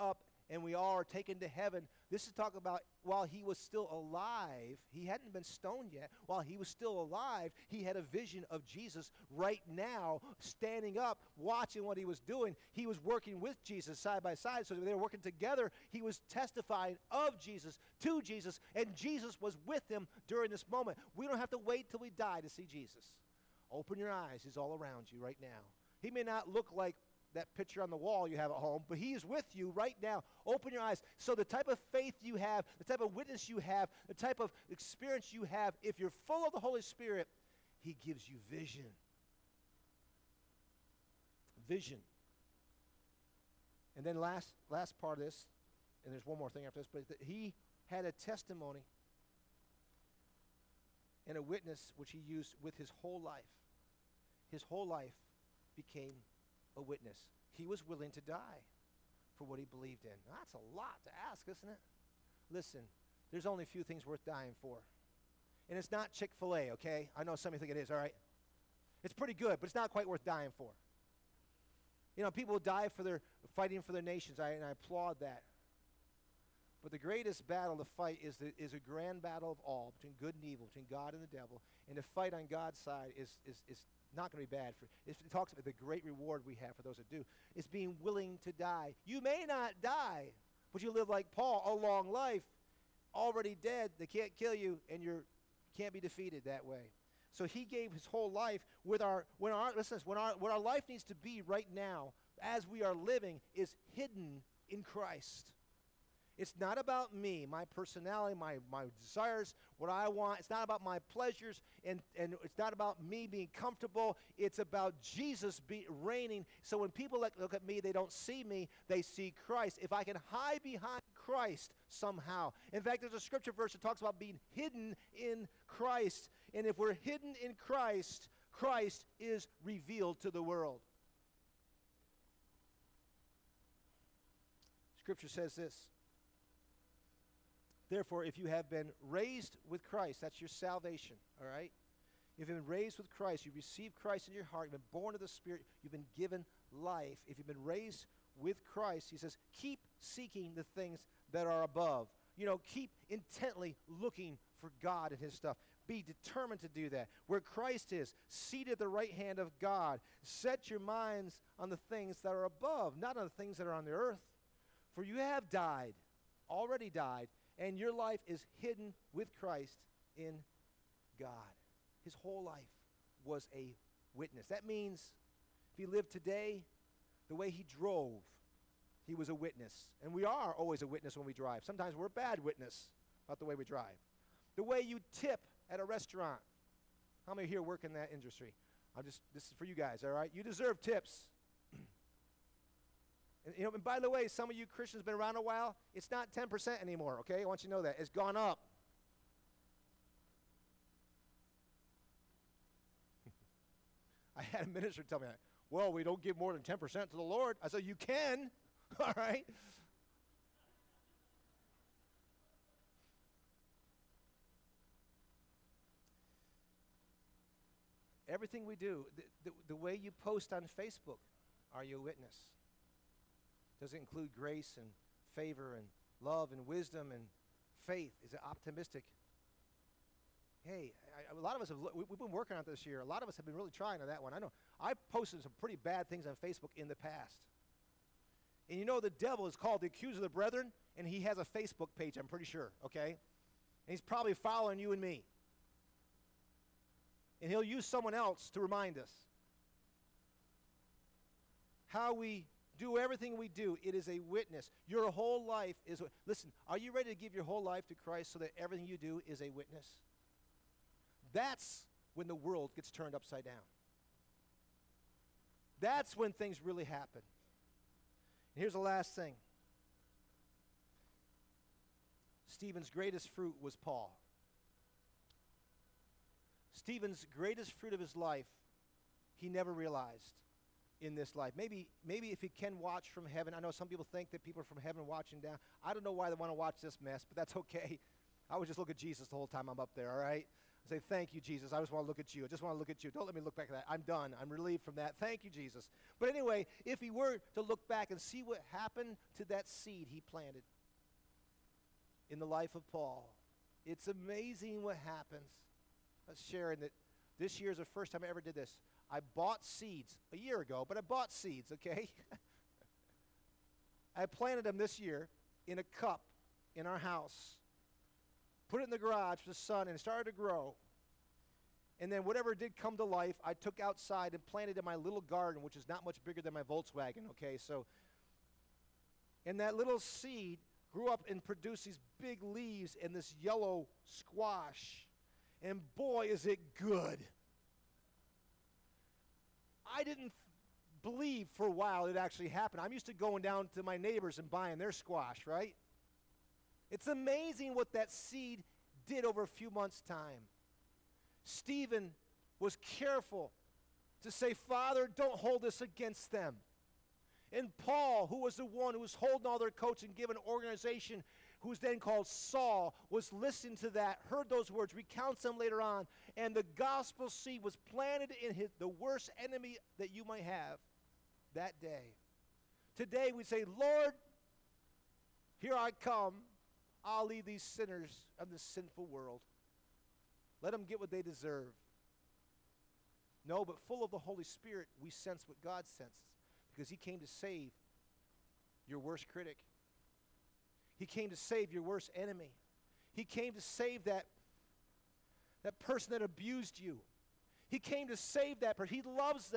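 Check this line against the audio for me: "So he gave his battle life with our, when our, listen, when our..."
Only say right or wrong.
wrong.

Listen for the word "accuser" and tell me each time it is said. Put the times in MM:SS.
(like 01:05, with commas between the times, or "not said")
03:59.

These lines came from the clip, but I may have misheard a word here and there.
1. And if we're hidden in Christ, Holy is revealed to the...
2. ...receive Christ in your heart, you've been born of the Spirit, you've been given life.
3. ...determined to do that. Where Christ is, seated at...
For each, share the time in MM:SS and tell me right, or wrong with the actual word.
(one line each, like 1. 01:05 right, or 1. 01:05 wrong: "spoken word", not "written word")
1. 02:06 wrong: "Christ", not "Holy"
2. 02:23 right
3. 02:36 right.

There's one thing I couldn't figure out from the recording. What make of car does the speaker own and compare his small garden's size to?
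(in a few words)
Volkswagen.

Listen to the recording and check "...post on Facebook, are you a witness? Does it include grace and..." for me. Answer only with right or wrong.
right.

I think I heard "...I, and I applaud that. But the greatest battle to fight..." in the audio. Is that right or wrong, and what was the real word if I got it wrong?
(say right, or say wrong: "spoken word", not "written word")
right.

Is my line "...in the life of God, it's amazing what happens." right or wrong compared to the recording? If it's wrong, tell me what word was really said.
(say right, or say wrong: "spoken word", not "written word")
wrong: "Paul", not "God".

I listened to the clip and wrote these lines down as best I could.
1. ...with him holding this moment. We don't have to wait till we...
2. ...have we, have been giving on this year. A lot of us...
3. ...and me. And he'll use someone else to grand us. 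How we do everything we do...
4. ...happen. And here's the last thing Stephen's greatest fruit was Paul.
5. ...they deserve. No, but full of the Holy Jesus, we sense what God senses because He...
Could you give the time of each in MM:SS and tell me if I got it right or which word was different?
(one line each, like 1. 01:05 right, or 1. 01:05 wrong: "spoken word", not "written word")
1. 00:19 wrong: "during", not "holding"
2. 03:51 wrong: "working", not "giving"
3. 04:04 wrong: "remind", not "grand"
4. 04:26 right
5. 06:21 wrong: "Spirit", not "Jesus".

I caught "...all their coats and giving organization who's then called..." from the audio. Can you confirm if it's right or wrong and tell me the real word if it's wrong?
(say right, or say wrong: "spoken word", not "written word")
right.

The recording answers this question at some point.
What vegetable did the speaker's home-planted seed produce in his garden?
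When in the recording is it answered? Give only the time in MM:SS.
05:33.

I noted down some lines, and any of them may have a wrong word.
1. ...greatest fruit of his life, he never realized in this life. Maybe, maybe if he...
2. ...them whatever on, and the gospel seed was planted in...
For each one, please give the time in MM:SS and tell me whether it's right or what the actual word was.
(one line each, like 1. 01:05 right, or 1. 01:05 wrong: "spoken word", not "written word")
1. 04:37 right
2. 06:05 wrong: "later", not "whatever".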